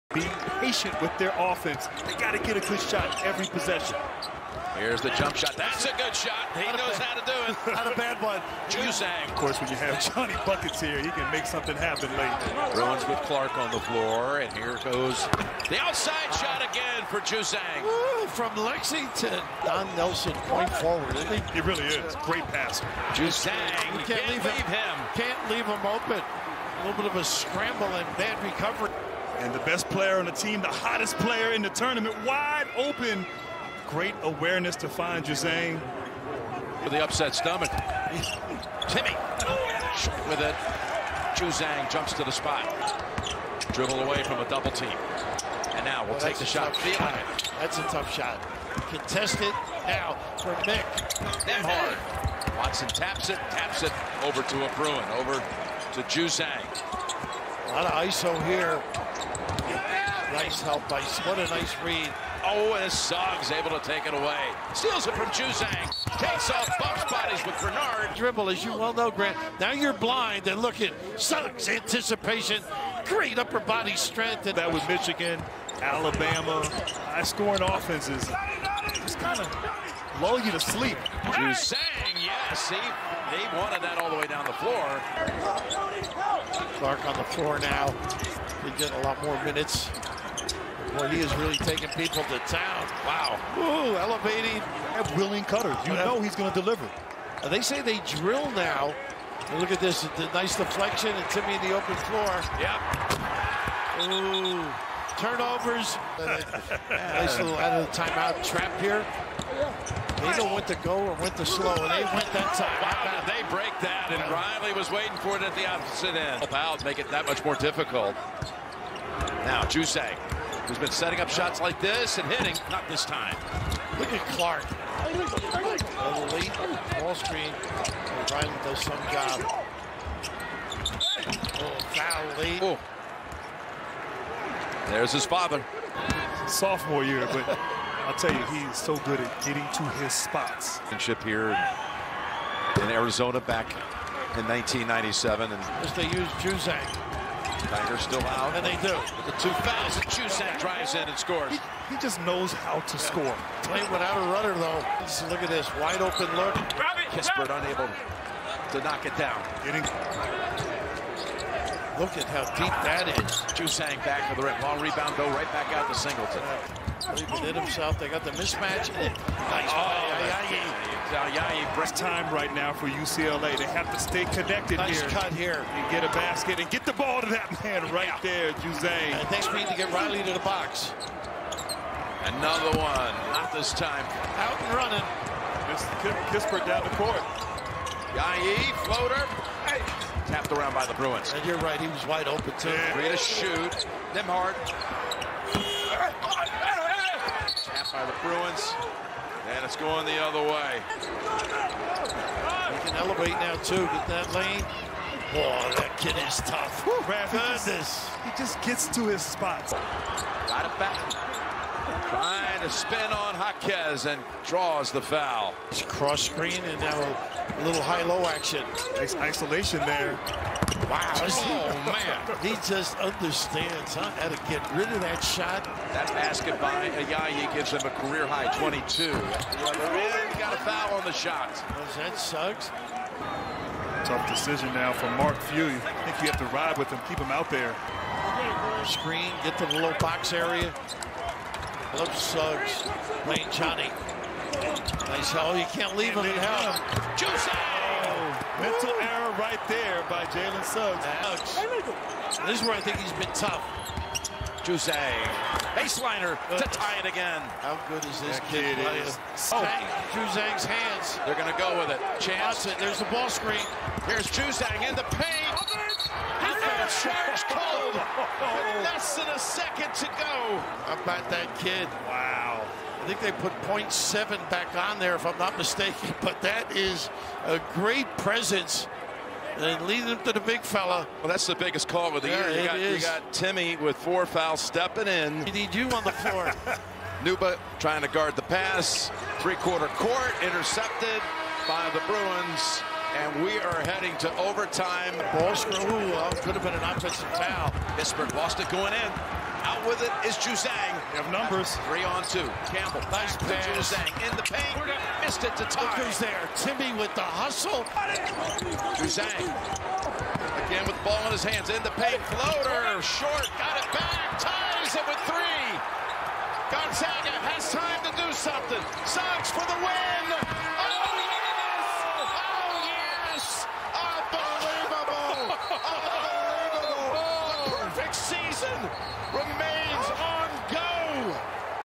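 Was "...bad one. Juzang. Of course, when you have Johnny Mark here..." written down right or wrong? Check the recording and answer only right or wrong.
wrong.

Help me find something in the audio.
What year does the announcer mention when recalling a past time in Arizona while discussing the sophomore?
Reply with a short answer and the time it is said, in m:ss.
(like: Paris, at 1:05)
1997, at 2:24.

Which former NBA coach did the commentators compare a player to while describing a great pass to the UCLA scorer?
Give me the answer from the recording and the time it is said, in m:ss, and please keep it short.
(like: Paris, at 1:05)
Don Nelson, at 0:19.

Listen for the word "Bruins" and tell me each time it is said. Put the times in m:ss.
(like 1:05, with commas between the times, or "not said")
0:12, 0:54, 3:10, 3:18, 4:52.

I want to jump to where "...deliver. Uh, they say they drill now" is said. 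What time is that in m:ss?
1:36.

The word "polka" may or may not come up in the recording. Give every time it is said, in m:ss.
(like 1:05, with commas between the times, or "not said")
not said.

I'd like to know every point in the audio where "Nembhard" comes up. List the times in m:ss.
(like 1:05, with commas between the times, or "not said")
0:51, 3:14.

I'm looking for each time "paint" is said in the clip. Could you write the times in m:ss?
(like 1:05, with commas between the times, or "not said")
4:25, 5:04, 5:11.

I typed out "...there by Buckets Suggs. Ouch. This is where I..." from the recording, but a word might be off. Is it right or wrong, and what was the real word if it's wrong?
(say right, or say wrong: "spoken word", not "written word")
wrong: "Jalen", not "Buckets".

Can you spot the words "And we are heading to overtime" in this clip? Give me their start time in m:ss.
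4:53.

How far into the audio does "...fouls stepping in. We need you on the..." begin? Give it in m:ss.
4:44.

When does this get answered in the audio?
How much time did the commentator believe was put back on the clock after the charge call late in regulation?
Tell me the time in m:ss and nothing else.
4:33.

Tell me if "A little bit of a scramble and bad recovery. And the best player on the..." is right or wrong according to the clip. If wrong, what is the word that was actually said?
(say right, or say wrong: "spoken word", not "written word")
right.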